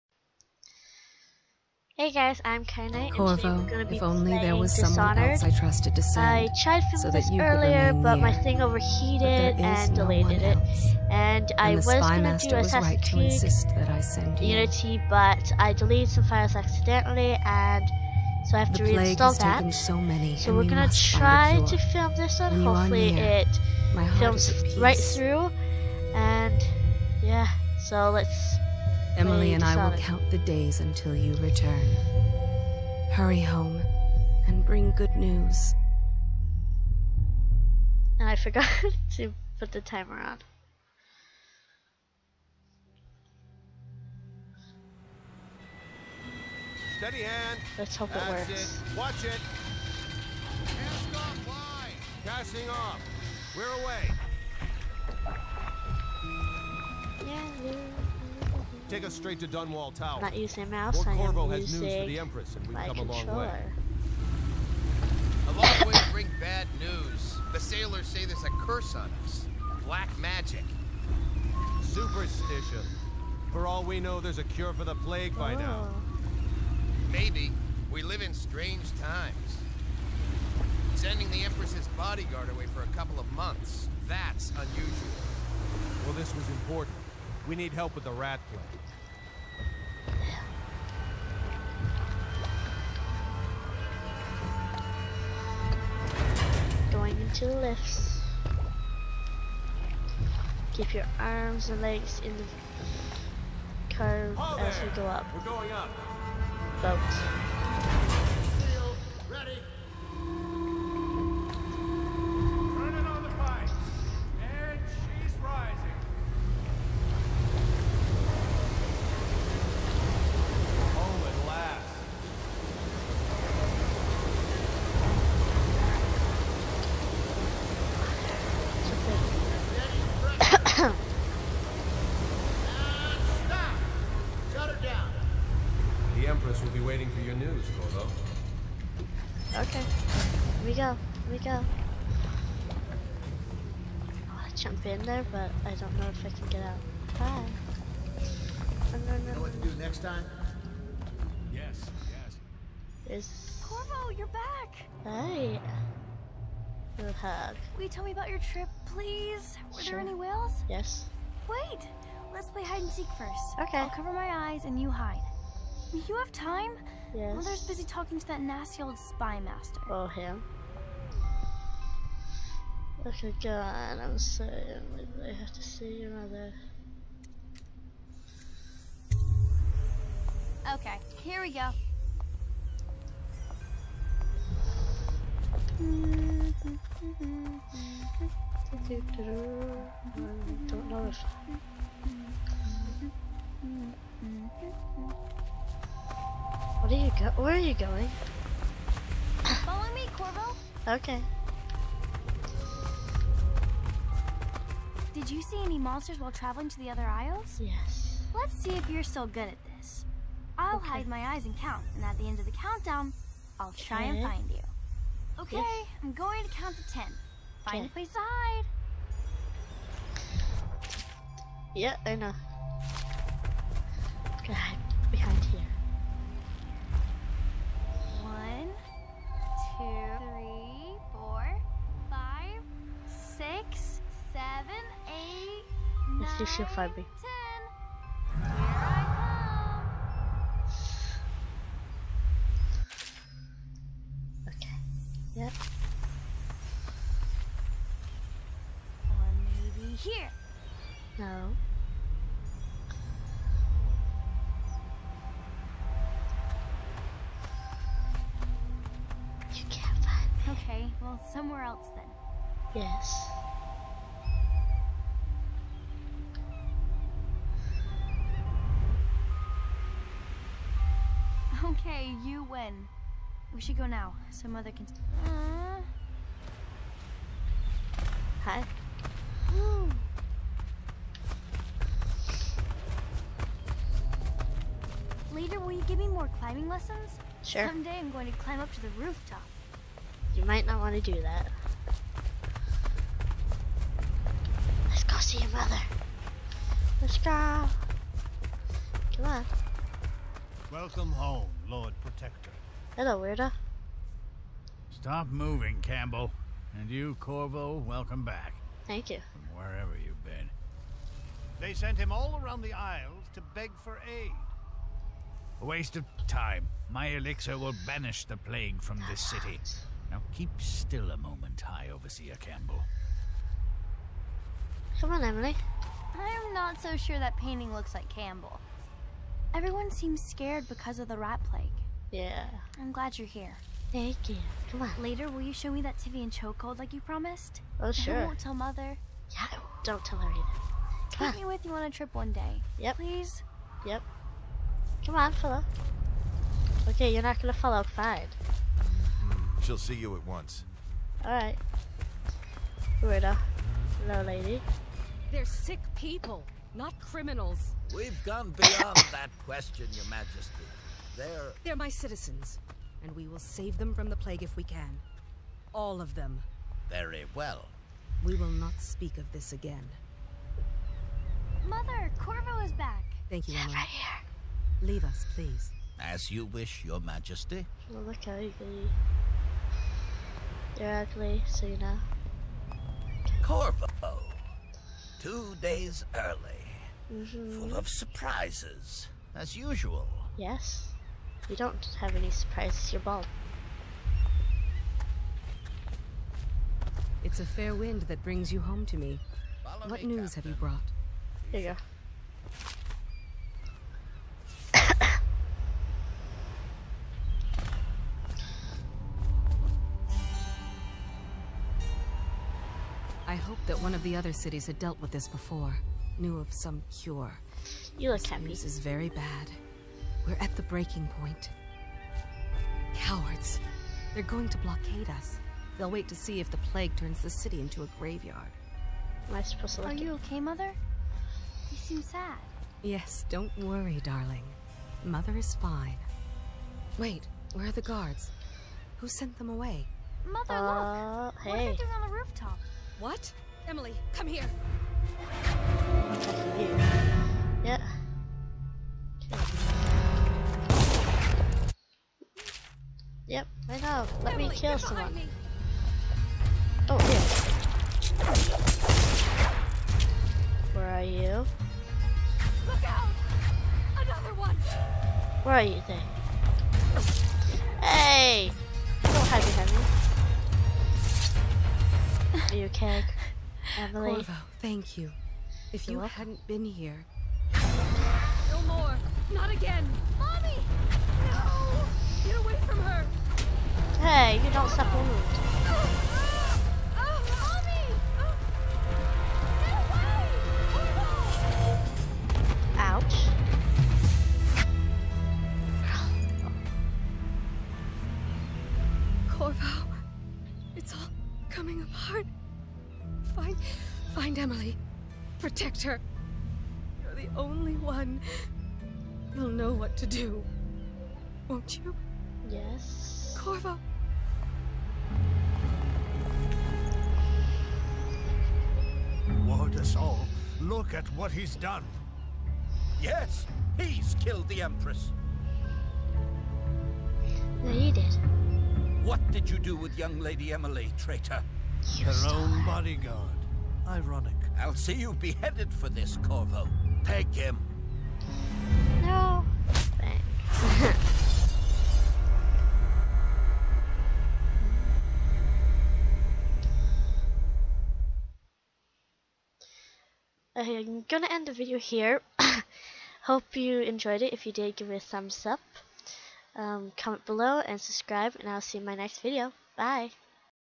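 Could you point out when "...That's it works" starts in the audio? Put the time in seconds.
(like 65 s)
48 s.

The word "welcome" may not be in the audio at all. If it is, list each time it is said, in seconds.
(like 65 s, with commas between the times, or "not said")
300 s, 307 s, 475 s.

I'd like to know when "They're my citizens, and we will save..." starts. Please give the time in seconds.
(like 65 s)
361 s.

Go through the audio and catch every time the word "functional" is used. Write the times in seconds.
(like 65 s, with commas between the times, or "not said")
not said.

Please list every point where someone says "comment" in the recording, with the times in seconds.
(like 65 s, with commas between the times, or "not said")
556 s.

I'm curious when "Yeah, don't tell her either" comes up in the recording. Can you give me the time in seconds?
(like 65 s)
339 s.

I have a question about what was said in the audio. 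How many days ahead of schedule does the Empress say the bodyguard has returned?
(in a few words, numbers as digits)
2.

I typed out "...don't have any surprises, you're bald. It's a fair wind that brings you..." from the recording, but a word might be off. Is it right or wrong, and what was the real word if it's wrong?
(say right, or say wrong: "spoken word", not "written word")
right.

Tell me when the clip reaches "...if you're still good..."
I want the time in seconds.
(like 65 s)
208 s.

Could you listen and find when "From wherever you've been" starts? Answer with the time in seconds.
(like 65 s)
309 s.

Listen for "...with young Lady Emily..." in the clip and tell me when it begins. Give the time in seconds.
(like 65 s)
529 s.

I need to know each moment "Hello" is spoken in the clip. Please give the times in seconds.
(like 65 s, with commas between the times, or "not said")
302 s, 354 s.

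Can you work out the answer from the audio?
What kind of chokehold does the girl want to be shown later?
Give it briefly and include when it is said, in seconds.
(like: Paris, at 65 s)
Tyvian chokehold, at 335 s.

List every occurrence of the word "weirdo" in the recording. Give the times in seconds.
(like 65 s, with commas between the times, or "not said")
303 s, 353 s.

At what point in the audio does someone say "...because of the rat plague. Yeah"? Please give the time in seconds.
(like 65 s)
330 s.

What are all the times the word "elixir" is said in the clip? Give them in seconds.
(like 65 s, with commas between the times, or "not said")
317 s.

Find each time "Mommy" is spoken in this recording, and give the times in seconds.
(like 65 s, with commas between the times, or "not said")
480 s.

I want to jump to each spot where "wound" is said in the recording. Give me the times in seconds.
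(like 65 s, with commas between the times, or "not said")
484 s.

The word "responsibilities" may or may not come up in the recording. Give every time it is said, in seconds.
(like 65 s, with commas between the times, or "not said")
not said.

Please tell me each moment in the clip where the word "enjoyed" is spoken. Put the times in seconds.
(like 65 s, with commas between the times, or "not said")
553 s.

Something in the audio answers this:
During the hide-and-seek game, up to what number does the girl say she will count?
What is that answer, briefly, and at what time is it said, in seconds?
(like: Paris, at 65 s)
10, at 216 s.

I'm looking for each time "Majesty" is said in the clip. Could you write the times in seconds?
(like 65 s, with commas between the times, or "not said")
360 s, 377 s.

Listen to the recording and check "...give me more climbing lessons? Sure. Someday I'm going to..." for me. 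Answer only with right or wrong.
right.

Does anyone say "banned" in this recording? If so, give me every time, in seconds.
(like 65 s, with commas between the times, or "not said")
not said.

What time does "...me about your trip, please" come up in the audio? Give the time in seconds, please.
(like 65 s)
158 s.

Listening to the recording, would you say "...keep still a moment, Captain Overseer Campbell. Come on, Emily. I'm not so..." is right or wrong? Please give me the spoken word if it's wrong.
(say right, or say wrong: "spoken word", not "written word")
wrong: "High", not "Captain".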